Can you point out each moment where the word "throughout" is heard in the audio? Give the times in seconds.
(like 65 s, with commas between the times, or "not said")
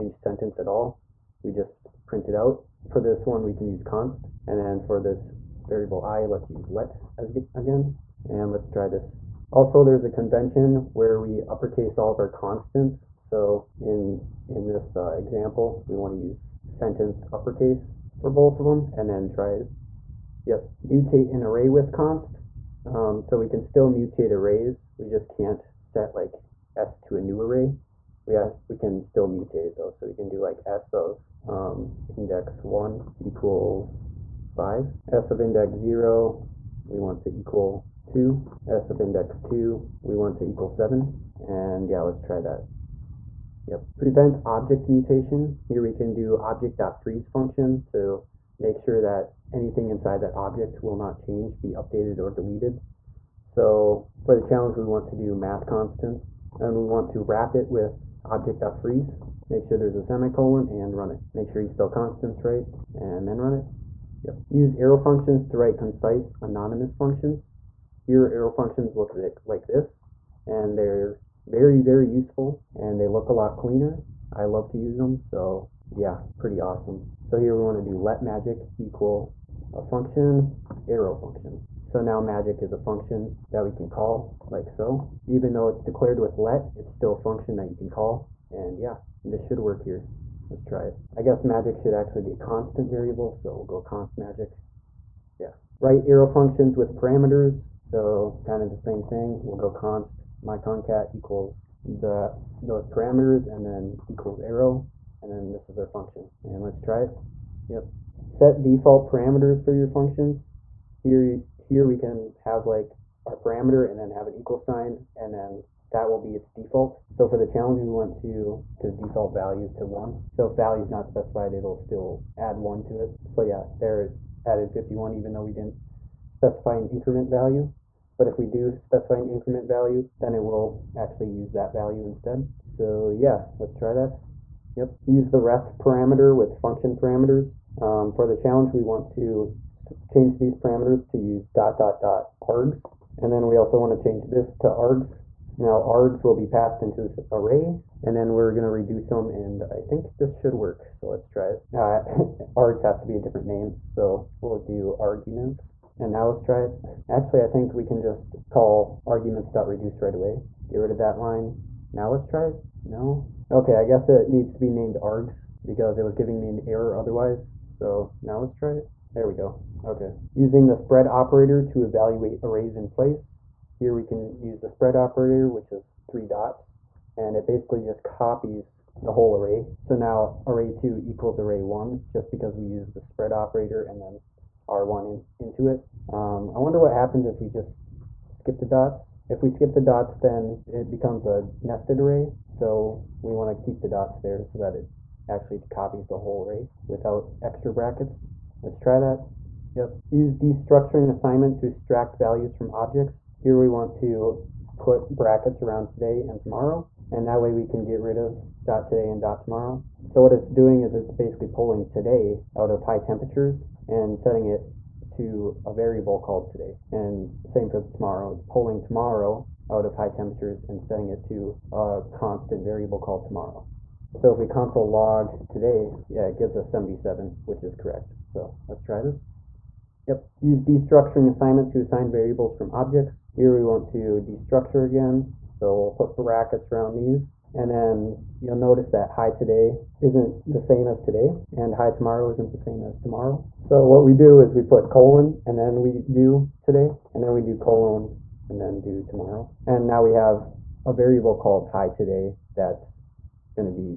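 not said.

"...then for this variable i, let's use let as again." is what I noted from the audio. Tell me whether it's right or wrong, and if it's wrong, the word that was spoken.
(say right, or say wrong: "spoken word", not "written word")
right.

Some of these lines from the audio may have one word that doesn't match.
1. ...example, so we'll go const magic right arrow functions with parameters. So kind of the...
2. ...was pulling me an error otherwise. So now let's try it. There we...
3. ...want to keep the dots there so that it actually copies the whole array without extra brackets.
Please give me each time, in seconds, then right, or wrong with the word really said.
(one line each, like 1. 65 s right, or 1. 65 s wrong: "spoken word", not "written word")
1. 92 s wrong: "variable", not "example"
2. 166 s wrong: "giving", not "pulling"
3. 193 s right.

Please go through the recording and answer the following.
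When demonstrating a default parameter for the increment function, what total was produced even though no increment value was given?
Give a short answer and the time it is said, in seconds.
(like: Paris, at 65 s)
51, at 124 s.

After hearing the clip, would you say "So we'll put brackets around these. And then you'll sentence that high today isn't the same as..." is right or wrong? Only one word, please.
wrong.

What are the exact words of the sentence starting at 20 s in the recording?
Yep, mutate an array with const.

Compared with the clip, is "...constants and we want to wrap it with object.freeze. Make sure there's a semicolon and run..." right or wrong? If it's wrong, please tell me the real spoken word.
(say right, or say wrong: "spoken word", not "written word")
right.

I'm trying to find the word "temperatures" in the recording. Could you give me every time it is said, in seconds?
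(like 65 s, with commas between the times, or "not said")
212 s, 220 s.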